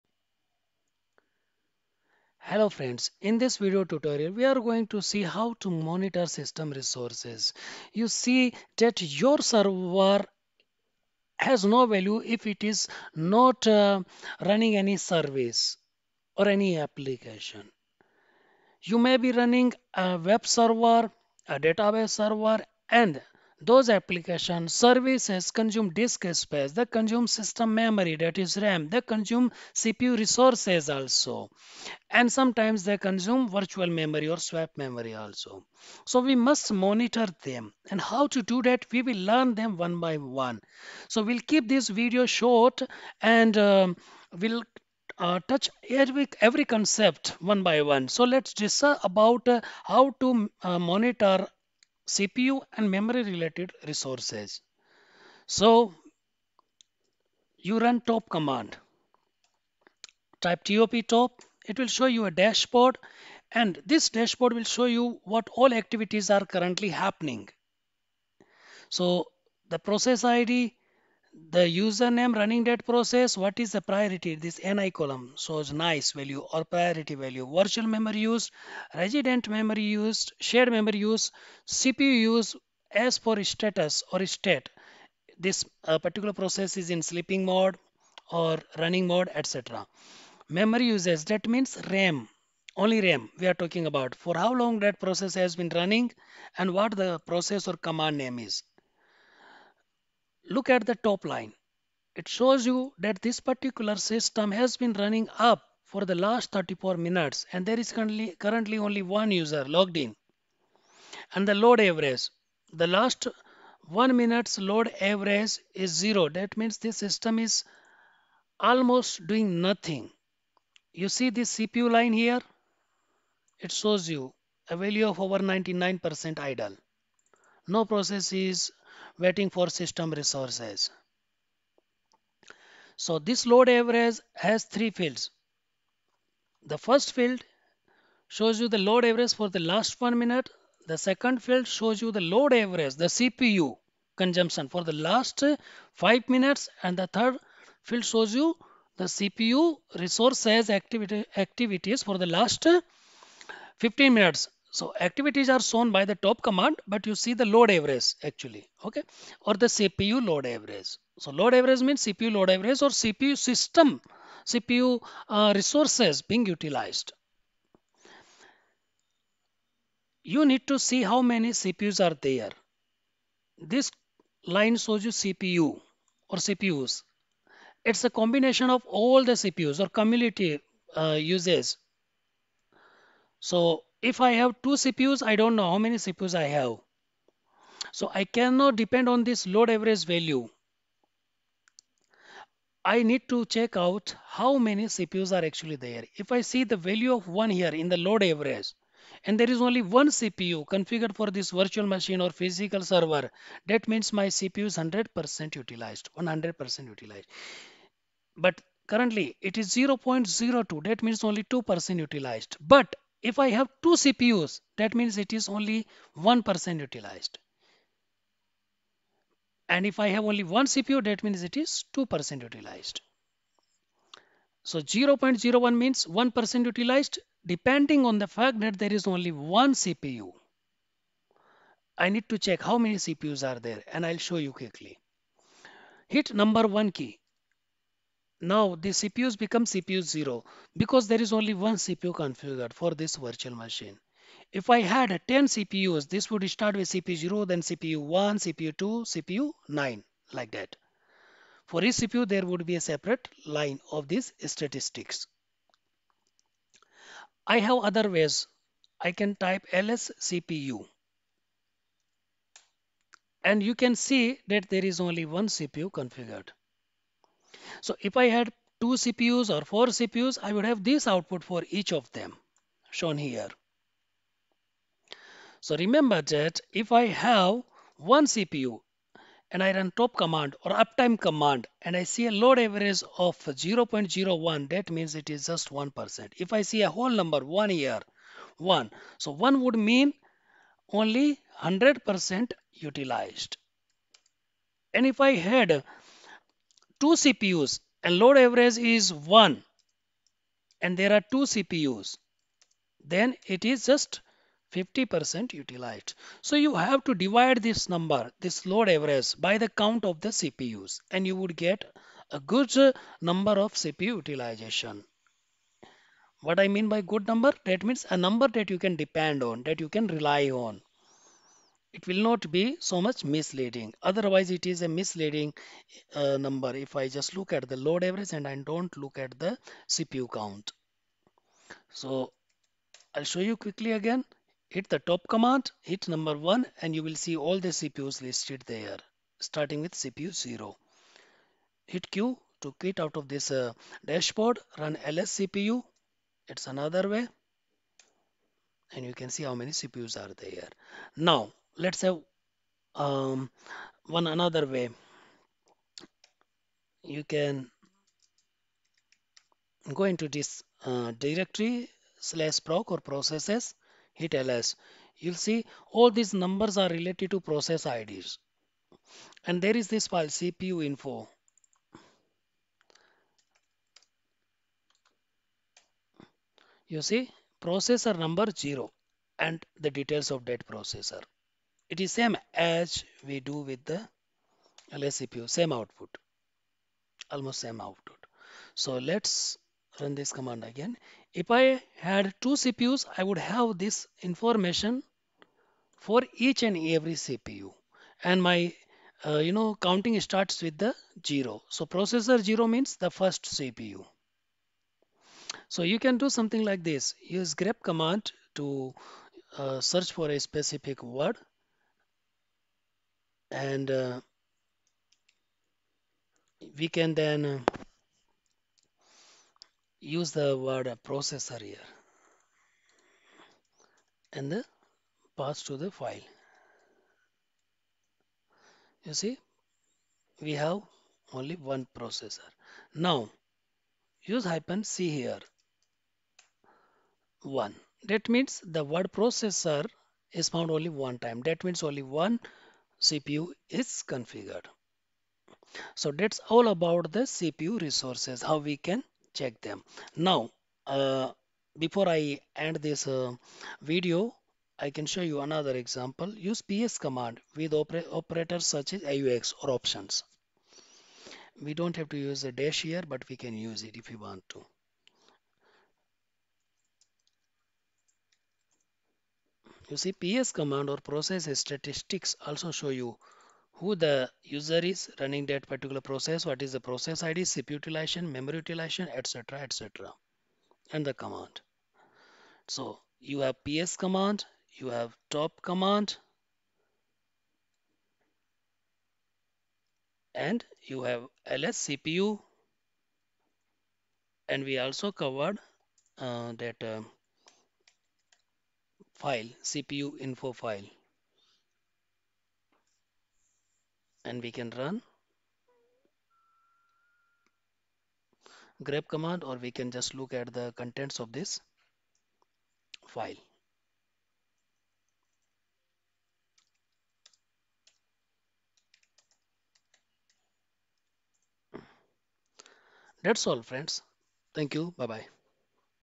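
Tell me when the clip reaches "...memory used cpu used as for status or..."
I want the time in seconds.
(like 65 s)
80 s.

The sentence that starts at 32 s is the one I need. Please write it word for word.
And sometimes they consume virtual memory or swap memory also.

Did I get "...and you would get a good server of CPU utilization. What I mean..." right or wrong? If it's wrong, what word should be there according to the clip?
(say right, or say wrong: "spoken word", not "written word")
wrong: "number", not "server".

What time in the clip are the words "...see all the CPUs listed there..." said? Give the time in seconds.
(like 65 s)
337 s.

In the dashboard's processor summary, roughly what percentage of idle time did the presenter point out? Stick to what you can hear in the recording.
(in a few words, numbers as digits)
over 99%.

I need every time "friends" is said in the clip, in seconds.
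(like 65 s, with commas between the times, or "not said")
2 s, 523 s.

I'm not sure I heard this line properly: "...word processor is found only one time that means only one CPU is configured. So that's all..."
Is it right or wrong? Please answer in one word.
right.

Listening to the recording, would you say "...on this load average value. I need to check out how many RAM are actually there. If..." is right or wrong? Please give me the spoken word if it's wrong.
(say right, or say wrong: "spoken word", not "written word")
wrong: "CPUs", not "RAM".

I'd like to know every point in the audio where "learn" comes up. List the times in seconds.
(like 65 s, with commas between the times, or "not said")
39 s.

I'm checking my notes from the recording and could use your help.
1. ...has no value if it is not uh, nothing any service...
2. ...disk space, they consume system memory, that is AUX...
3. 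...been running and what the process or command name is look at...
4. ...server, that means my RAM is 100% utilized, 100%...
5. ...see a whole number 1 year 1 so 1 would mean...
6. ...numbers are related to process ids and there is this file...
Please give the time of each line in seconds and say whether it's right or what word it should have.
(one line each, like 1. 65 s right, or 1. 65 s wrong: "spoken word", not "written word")
1. 11 s wrong: "running", not "nothing"
2. 25 s wrong: "RAM", not "AUX"
3. 95 s right
4. 202 s wrong: "CPU", not "RAM"
5. 286 s right
6. 366 s right.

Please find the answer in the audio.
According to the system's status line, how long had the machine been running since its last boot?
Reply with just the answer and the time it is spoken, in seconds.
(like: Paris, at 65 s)
34 minutes, at 106 s.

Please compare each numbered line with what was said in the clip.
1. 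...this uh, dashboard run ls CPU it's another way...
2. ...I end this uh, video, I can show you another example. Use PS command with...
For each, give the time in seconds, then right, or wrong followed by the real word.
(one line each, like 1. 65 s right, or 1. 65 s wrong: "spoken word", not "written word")
1. 343 s right
2. 452 s right.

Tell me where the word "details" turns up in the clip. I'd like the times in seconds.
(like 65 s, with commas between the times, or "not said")
379 s.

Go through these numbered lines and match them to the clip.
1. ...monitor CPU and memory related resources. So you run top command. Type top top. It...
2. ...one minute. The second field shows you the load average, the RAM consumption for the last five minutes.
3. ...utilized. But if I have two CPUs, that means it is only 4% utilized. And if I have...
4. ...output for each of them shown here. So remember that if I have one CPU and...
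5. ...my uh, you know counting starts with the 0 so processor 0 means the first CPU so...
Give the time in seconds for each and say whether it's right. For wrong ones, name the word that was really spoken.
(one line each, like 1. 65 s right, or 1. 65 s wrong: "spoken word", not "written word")
1. 50 s right
2. 140 s wrong: "CPU", not "RAM"
3. 211 s wrong: "1", not "4"
4. 271 s right
5. 398 s right.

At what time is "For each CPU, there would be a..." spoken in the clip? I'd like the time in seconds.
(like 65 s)
251 s.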